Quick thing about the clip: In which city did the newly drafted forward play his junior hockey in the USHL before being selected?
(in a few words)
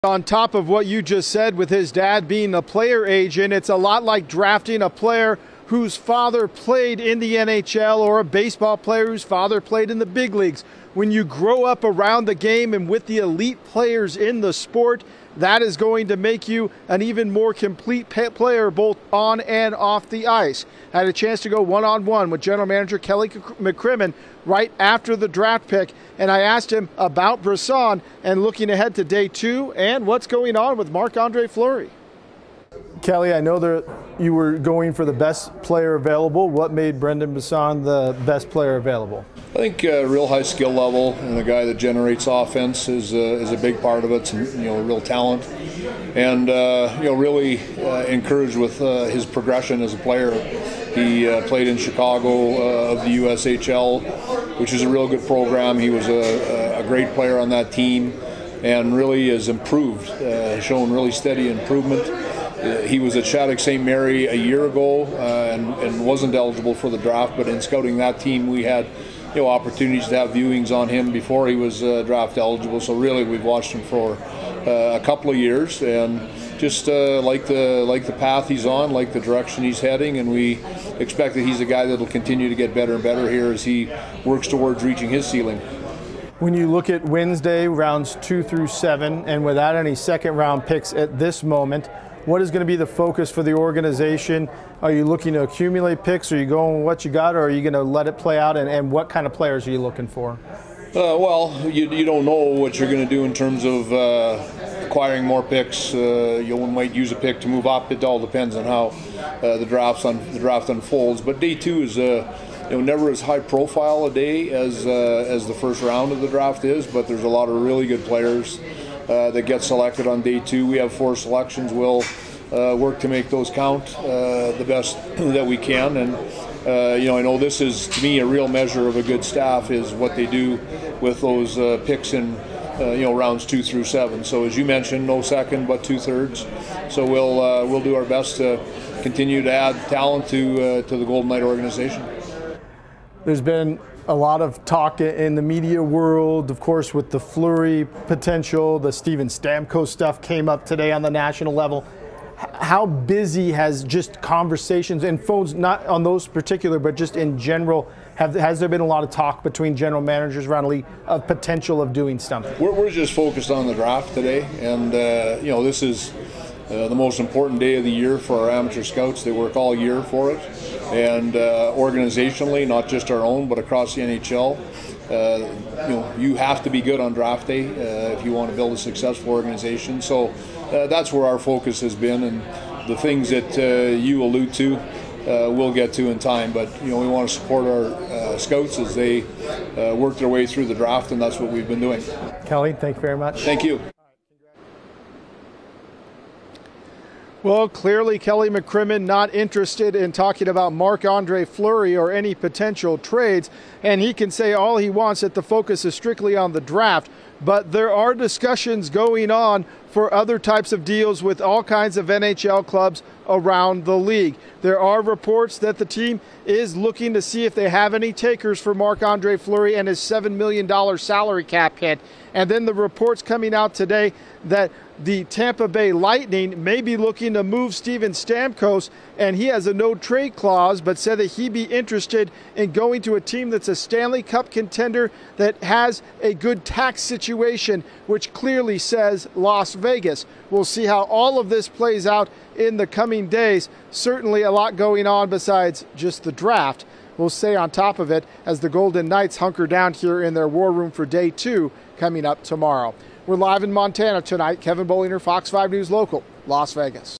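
Chicago.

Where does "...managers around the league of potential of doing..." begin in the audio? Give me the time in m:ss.
2:40.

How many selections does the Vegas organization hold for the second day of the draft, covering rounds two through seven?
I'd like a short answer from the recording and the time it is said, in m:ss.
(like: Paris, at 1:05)
4, at 2:00.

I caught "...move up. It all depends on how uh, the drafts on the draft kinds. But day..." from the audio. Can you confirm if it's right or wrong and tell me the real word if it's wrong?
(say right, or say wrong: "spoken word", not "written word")
wrong: "unfolds", not "kinds".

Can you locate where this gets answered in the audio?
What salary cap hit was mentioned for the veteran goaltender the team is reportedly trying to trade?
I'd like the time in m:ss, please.
3:39.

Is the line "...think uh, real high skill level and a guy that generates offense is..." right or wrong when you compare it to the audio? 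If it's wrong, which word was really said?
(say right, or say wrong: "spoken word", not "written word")
right.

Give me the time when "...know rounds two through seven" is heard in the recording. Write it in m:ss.
2:13.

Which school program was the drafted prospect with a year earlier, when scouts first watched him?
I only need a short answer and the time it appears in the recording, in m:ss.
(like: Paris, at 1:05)
Shattuck St. Mary, at 1:03.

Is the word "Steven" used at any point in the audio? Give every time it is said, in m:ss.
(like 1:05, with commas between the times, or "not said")
2:28, 3:47.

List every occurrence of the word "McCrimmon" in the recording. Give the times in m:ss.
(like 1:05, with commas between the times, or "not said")
0:23, 3:18.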